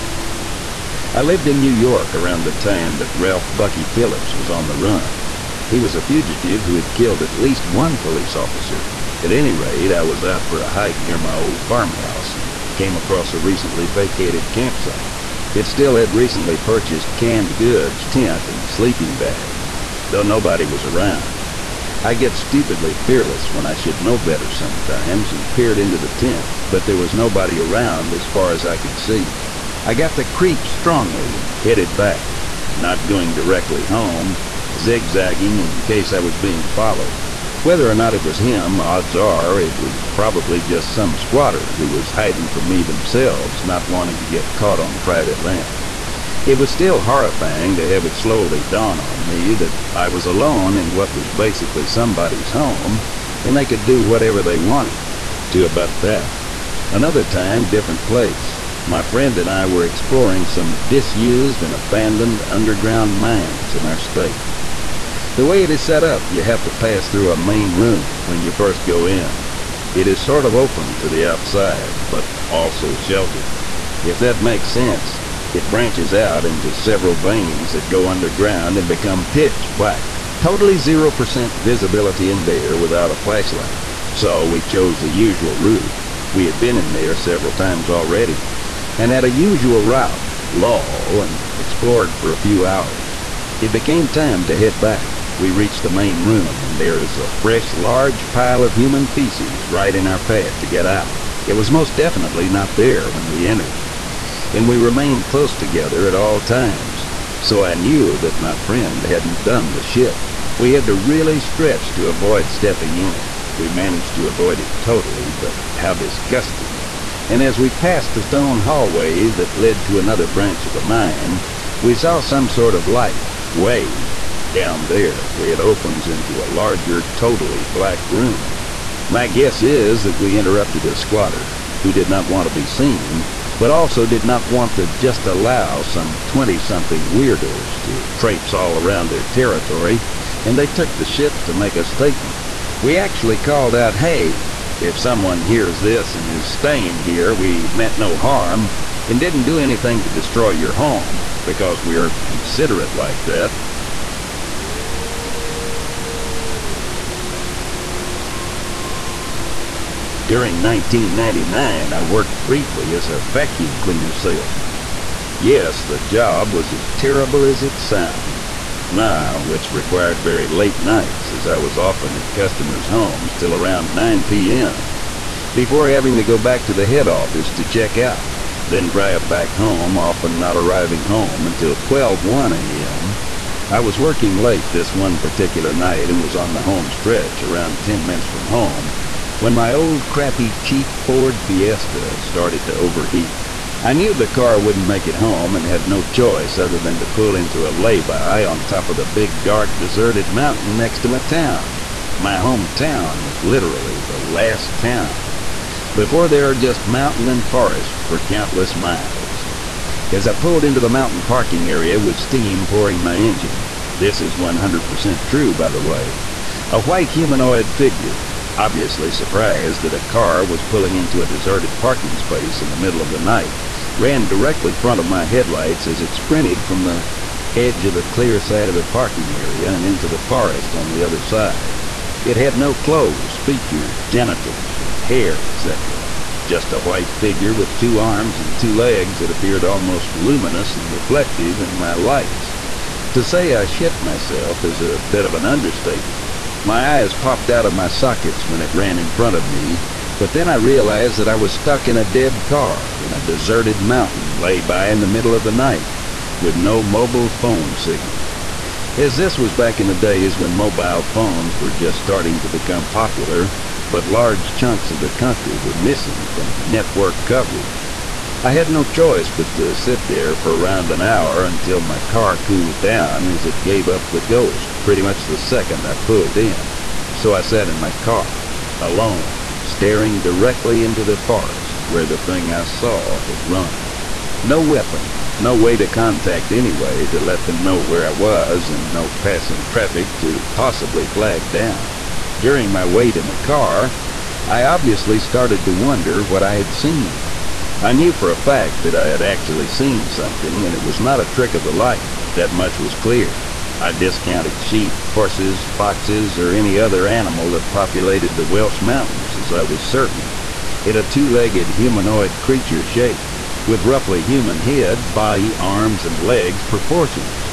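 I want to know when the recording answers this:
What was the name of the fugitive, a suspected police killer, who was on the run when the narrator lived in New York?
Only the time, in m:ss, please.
0:03.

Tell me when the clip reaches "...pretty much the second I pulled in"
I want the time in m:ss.
4:34.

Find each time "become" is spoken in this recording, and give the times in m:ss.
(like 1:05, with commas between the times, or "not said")
1:18, 4:22.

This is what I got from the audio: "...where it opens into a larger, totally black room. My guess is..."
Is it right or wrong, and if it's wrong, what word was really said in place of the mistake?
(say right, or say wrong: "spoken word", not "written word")
right.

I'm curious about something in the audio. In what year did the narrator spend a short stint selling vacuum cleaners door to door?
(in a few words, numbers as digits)
1999.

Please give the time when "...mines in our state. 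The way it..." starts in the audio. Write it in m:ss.
1:03.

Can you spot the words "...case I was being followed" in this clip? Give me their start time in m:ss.
0:35.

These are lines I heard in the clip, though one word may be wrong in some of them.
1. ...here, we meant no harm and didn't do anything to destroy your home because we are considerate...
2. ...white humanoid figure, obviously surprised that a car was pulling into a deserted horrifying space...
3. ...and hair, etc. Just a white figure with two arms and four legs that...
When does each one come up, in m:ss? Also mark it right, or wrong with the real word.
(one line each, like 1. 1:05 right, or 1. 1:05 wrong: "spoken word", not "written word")
1. 2:27 right
2. 3:36 wrong: "parking", not "horrifying"
3. 3:54 wrong: "two", not "four".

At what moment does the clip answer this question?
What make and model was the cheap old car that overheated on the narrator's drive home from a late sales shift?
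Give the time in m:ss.
3:11.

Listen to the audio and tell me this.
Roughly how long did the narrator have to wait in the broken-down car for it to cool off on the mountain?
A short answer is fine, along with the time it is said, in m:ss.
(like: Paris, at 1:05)
an hour, at 4:30.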